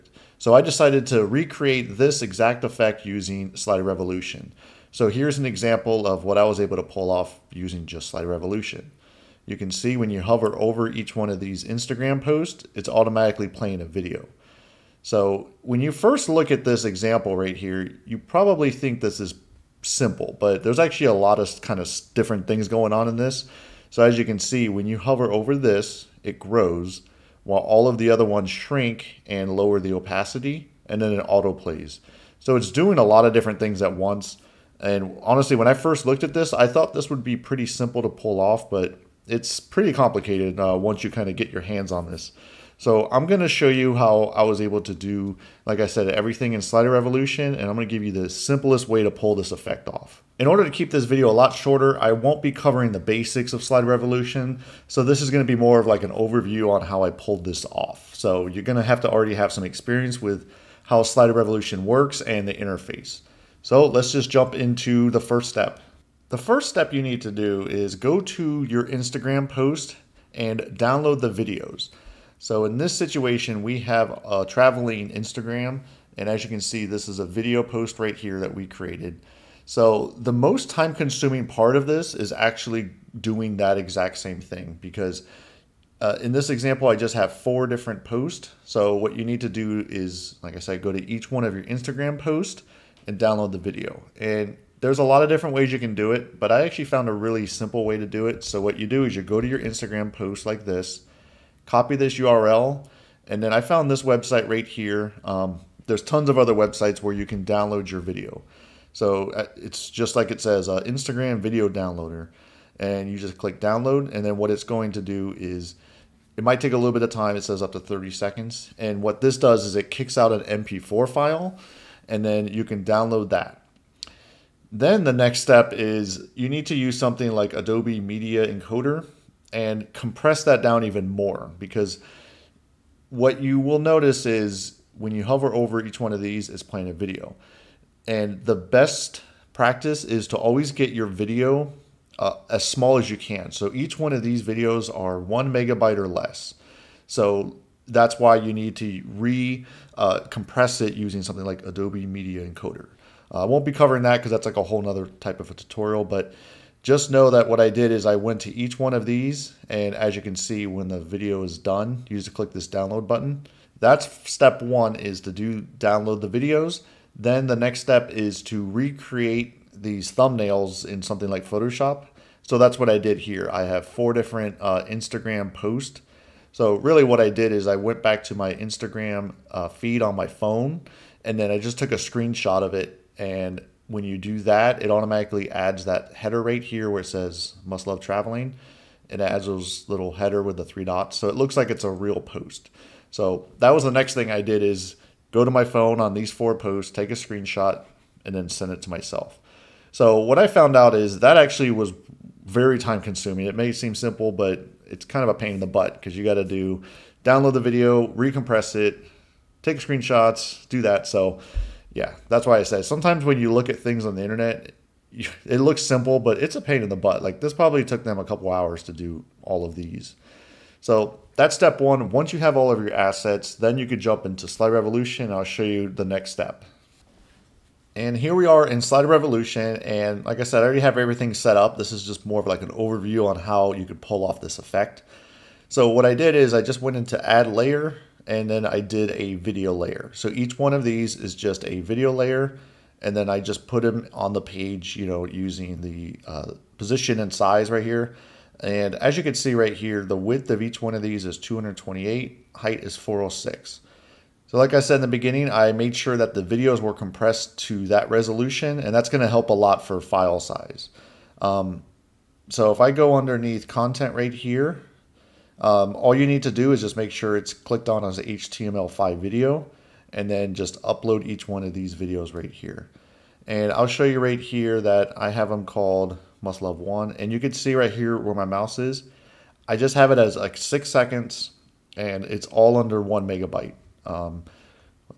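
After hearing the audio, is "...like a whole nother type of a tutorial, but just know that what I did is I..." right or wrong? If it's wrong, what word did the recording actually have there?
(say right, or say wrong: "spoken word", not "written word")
right.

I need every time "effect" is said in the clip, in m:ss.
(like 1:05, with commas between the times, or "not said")
0:02, 0:49, 3:54.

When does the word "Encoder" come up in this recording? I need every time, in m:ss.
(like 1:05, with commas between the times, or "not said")
2:08, 2:32.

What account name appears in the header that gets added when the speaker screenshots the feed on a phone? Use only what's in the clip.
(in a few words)
Must Love Traveling.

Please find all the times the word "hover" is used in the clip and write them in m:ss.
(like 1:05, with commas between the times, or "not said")
0:10, 0:24, 2:15.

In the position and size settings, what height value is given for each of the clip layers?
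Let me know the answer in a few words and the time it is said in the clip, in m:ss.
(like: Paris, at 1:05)
406, at 4:12.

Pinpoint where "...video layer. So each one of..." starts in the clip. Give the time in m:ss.
3:59.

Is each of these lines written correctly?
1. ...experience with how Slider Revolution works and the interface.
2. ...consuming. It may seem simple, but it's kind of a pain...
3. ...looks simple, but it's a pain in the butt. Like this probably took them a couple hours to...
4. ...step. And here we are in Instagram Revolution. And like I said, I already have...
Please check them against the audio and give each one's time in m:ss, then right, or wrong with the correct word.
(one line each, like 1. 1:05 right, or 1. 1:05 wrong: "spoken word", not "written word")
1. 0:59 right
2. 3:23 right
3. 3:35 right
4. 3:46 wrong: "Slider", not "Instagram".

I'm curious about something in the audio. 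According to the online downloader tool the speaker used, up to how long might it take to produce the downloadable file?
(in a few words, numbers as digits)
30 seconds.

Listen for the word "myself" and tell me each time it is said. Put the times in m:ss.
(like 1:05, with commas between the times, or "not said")
3:18.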